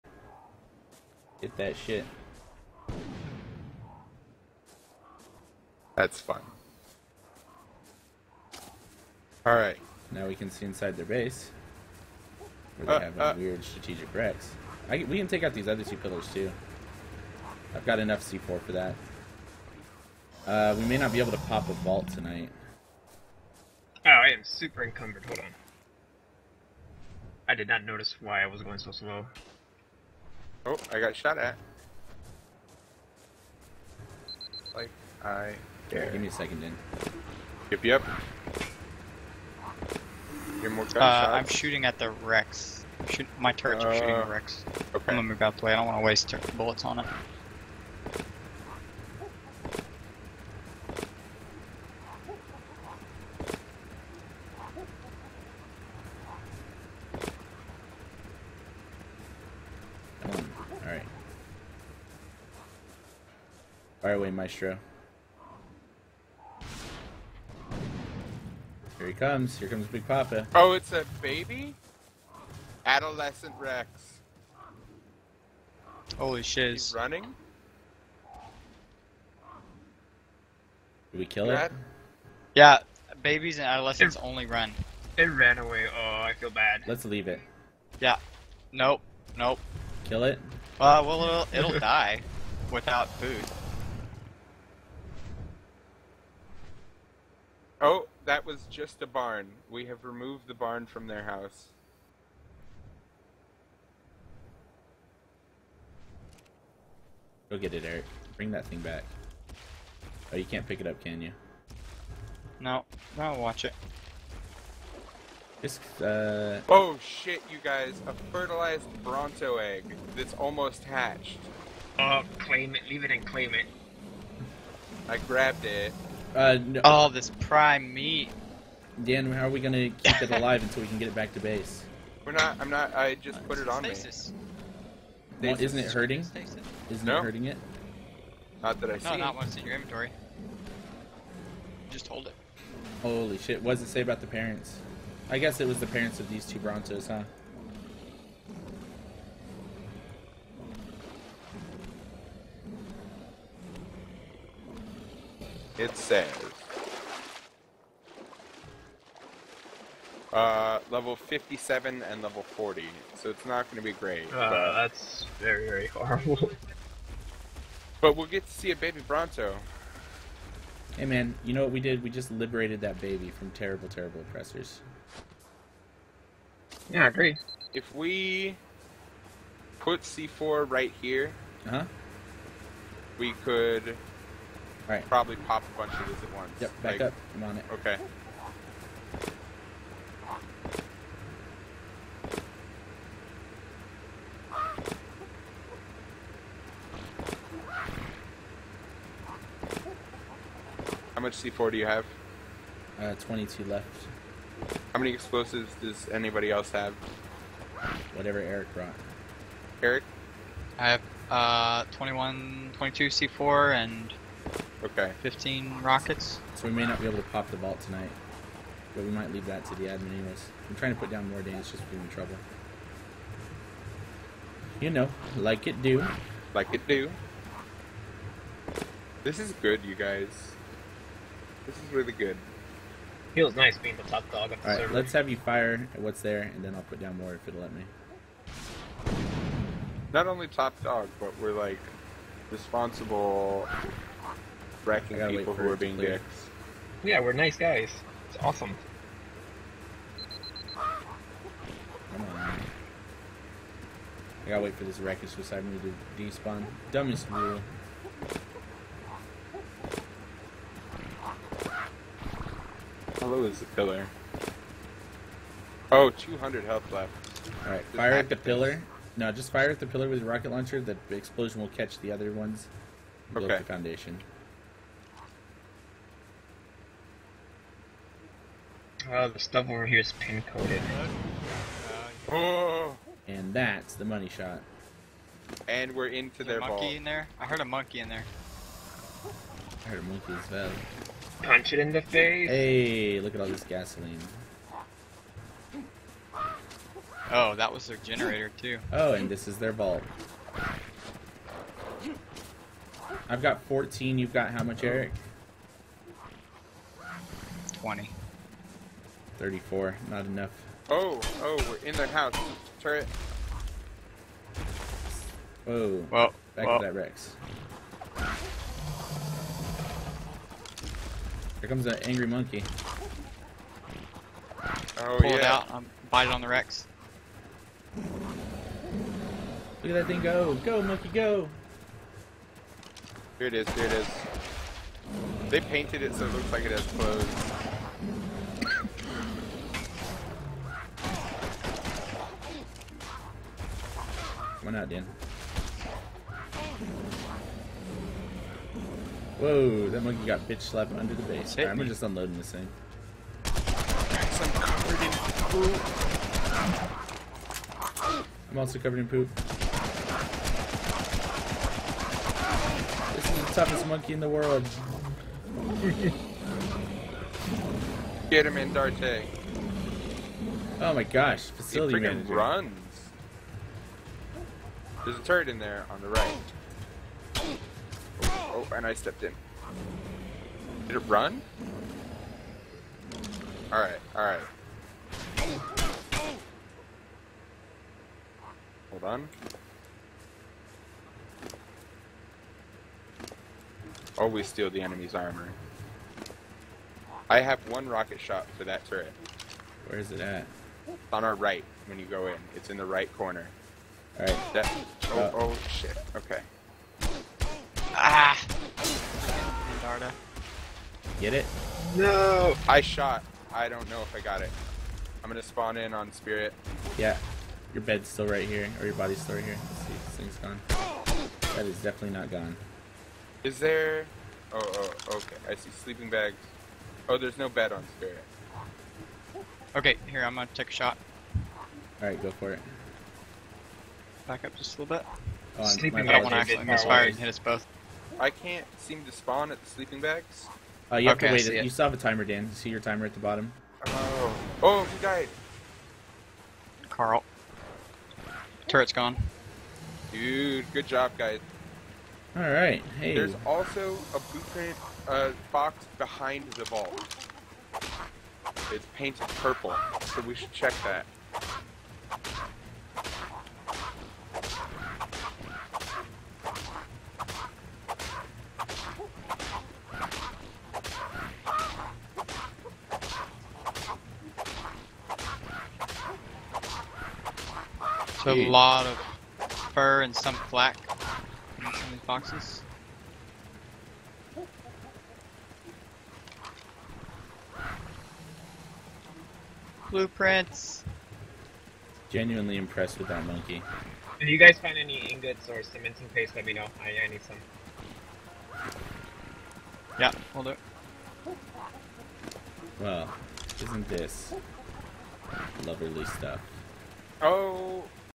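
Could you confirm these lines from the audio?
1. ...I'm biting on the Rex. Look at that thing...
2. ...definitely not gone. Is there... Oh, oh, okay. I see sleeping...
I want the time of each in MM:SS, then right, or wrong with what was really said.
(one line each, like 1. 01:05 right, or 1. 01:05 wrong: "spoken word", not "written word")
1. 05:25 right
2. 07:01 right.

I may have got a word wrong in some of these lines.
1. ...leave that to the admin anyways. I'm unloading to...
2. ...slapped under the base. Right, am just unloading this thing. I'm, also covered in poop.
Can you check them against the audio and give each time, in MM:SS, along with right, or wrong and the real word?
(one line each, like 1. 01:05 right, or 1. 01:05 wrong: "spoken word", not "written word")
1. 03:39 wrong: "trying", not "unloading"
2. 05:50 right.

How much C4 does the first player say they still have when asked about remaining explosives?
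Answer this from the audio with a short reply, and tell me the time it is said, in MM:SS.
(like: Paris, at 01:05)
22, at 03:23.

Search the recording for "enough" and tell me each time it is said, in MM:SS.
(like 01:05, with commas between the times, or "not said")
00:17, 05:10.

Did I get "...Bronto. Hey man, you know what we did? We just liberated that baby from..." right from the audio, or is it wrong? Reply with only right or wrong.
right.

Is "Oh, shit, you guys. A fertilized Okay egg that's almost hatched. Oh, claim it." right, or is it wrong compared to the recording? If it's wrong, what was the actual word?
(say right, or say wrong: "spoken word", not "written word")
wrong: "Bronto", not "Okay".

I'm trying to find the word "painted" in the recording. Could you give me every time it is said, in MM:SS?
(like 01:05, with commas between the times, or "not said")
05:35, 07:38.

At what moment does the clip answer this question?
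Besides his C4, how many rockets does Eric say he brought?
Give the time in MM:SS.
03:35.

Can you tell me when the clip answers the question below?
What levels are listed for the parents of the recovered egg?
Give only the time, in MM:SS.
02:40.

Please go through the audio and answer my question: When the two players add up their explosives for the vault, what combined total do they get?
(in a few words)
34.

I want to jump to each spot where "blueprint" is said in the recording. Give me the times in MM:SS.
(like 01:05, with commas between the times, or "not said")
07:34, 08:09.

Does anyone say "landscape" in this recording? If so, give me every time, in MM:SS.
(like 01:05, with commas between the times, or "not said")
not said.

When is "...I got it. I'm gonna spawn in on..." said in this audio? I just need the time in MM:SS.
06:54.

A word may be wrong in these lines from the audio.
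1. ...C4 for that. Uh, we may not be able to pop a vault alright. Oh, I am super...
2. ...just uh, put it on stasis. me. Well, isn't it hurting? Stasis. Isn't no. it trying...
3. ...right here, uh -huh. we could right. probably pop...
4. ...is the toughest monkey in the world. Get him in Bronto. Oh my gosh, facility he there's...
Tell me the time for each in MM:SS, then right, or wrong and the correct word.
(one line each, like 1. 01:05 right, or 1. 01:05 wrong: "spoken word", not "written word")
1. 00:18 wrong: "tonight", not "alright"
2. 02:13 wrong: "hurting", not "trying"
3. 03:00 right
4. 06:03 wrong: "Darte", not "Bronto".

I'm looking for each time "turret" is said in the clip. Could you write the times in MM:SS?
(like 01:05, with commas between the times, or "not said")
00:43, 05:12, 06:15, 06:38, 07:28.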